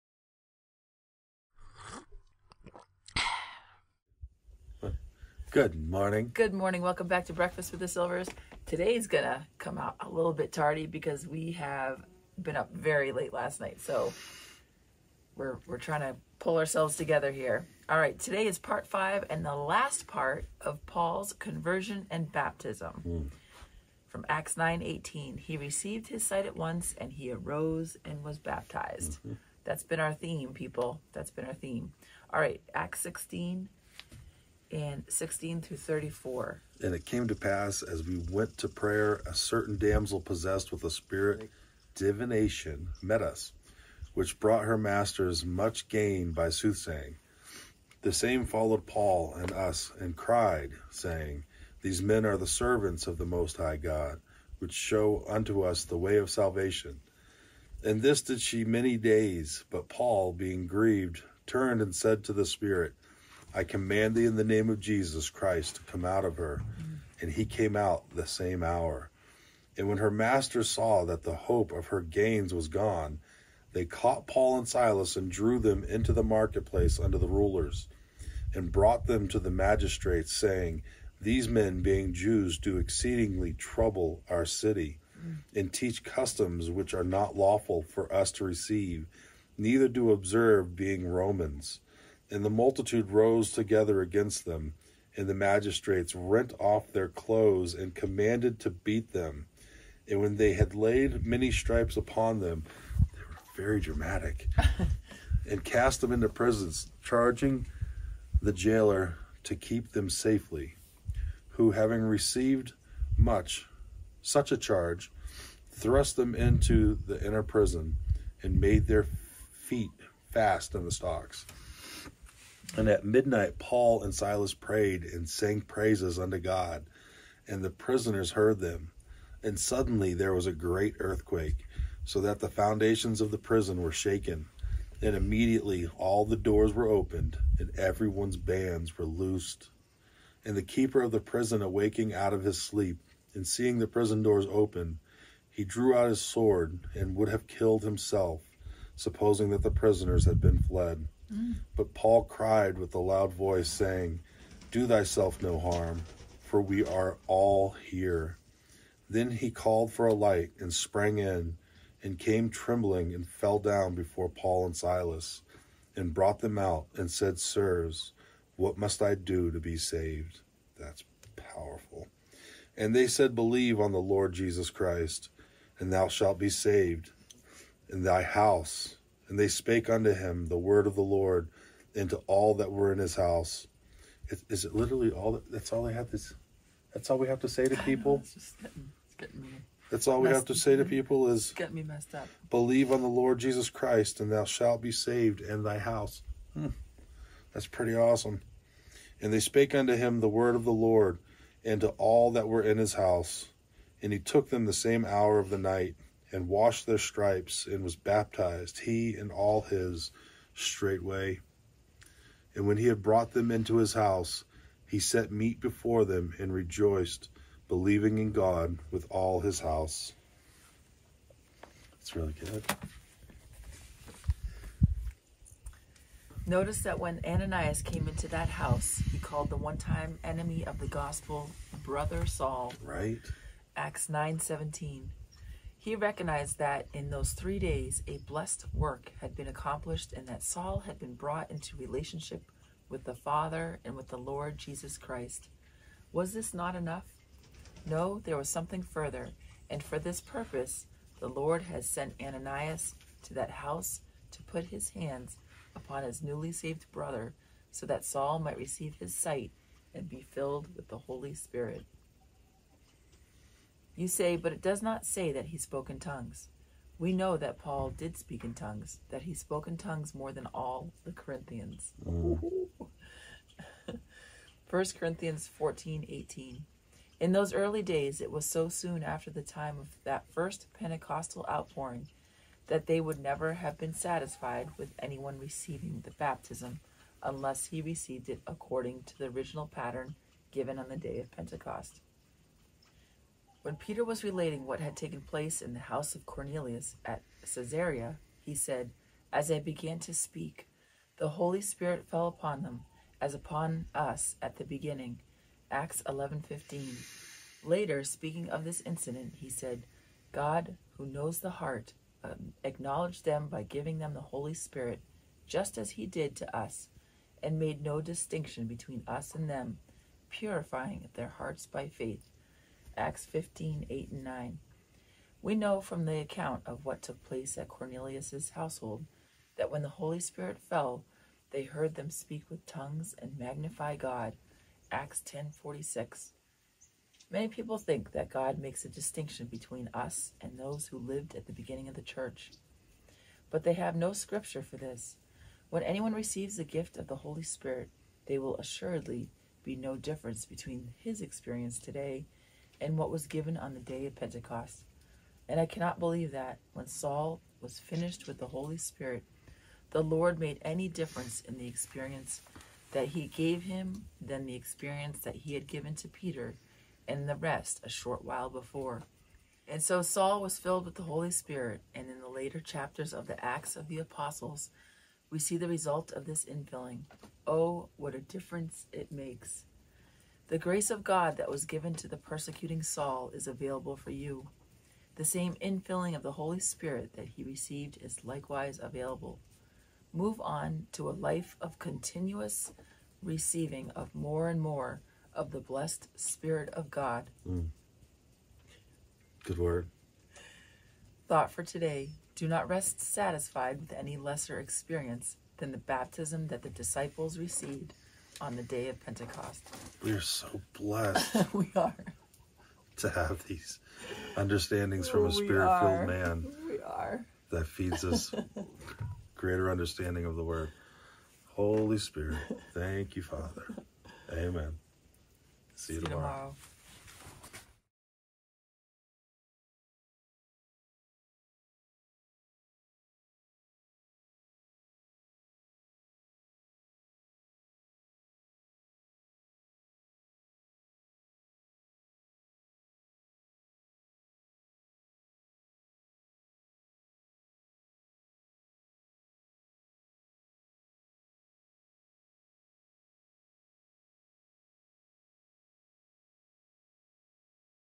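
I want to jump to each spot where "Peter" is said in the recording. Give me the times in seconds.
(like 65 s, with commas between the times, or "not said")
293 s, 366 s.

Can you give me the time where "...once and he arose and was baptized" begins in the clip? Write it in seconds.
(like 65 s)
26 s.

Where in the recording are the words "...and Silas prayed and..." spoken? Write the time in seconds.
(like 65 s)
124 s.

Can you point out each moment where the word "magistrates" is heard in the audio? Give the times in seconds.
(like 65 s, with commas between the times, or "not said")
79 s, 95 s.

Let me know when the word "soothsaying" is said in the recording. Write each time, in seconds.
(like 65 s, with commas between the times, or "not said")
46 s.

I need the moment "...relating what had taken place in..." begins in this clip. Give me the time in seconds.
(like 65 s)
294 s.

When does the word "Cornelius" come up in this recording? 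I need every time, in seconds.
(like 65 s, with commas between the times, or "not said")
296 s, 327 s.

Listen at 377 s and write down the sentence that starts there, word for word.
Oh, what a difference it makes!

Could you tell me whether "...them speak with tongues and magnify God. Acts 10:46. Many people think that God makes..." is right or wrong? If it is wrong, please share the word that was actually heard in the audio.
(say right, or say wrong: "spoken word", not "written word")
right.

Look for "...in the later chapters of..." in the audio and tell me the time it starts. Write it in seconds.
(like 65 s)
372 s.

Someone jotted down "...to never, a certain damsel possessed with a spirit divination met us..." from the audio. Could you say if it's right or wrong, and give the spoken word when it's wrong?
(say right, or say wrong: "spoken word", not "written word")
wrong: "prayer", not "never".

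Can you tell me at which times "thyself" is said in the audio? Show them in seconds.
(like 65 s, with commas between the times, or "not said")
154 s.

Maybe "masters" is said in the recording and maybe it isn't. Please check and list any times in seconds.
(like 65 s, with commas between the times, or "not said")
44 s, 70 s.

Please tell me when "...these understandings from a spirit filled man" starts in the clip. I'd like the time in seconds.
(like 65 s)
413 s.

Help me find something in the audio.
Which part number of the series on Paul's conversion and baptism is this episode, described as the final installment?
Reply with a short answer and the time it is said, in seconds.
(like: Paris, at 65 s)
5, at 18 s.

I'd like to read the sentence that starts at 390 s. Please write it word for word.
Move on to a life of continuous receiving of more and more of the blessed Spirit of God.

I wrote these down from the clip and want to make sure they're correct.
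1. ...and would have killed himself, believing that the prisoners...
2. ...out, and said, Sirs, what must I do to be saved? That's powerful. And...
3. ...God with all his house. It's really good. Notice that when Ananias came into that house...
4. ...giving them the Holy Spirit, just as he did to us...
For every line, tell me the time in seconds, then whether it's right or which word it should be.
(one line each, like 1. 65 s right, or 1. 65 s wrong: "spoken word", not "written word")
1. 146 s wrong: "supposing", not "believing"
2. 166 s right
3. 218 s right
4. 313 s right.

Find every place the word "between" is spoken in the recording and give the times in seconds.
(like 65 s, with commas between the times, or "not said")
318 s, 339 s, 350 s.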